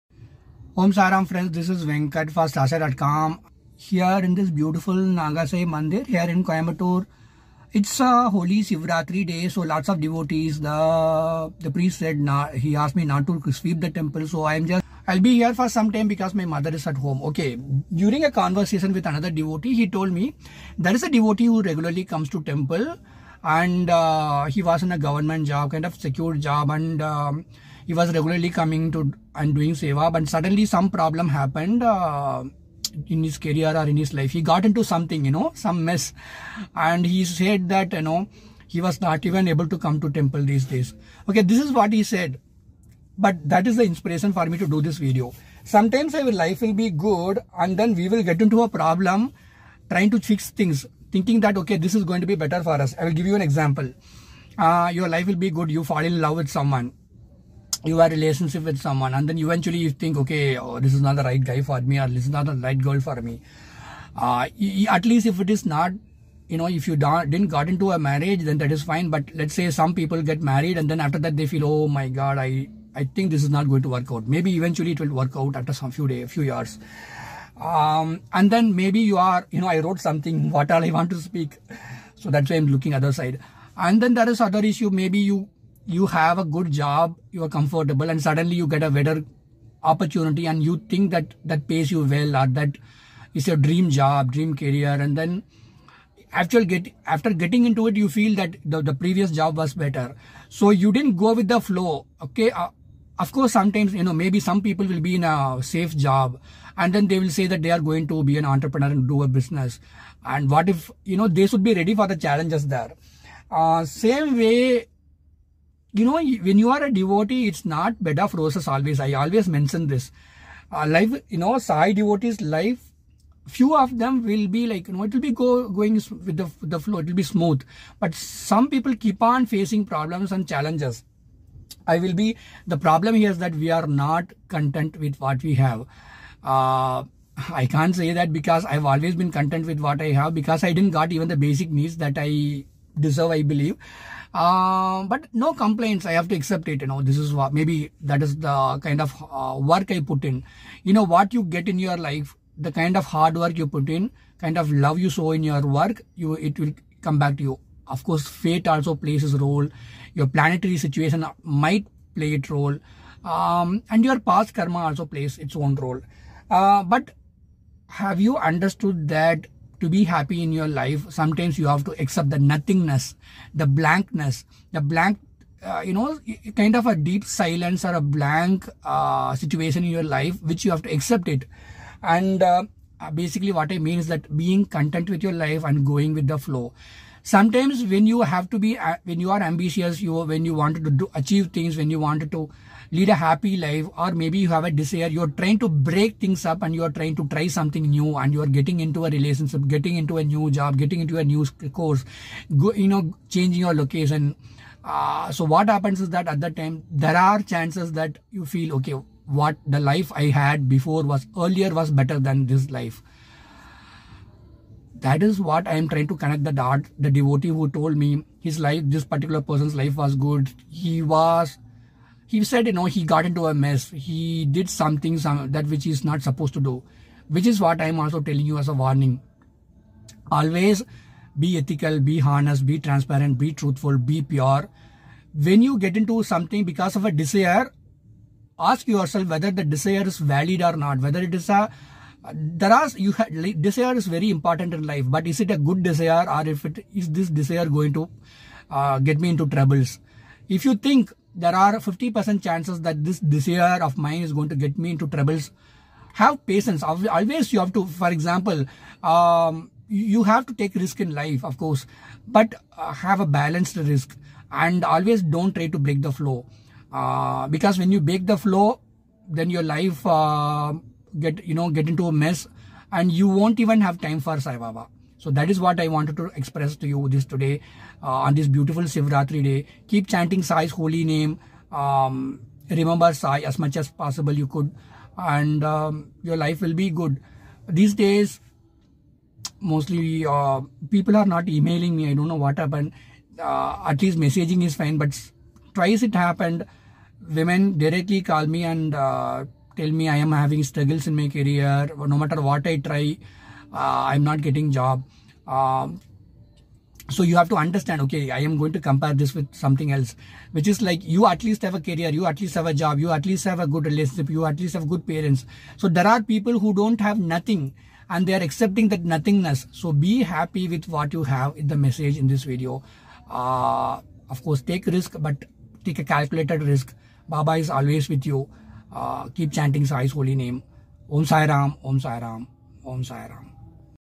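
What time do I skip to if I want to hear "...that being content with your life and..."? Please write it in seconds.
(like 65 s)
184 s.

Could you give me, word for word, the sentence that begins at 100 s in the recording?
So you didn't go with the flow.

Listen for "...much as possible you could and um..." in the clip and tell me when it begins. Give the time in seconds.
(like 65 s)
283 s.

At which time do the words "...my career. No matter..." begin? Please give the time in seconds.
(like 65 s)
301 s.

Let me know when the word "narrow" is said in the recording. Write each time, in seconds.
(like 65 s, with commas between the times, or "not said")
not said.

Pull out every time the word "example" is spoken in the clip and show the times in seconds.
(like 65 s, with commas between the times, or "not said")
53 s, 258 s.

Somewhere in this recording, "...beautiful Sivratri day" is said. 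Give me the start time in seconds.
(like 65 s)
278 s.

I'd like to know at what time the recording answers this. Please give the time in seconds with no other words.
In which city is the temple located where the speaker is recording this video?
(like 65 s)
6 s.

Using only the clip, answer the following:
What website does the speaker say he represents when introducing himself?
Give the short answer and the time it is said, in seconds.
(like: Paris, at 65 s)
StarSai.com, at 2 s.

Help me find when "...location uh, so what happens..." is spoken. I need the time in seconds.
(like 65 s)
203 s.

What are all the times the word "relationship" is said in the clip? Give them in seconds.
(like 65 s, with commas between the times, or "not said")
58 s, 199 s, 313 s.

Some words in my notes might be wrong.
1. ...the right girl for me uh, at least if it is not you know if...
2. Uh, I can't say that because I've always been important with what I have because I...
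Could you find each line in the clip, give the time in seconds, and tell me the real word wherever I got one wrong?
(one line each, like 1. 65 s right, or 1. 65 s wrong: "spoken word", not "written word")
1. 62 s right
2. 136 s wrong: "content", not "important".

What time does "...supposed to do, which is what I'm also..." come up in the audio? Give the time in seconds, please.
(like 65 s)
226 s.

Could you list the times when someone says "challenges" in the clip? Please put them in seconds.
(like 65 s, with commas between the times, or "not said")
112 s, 130 s.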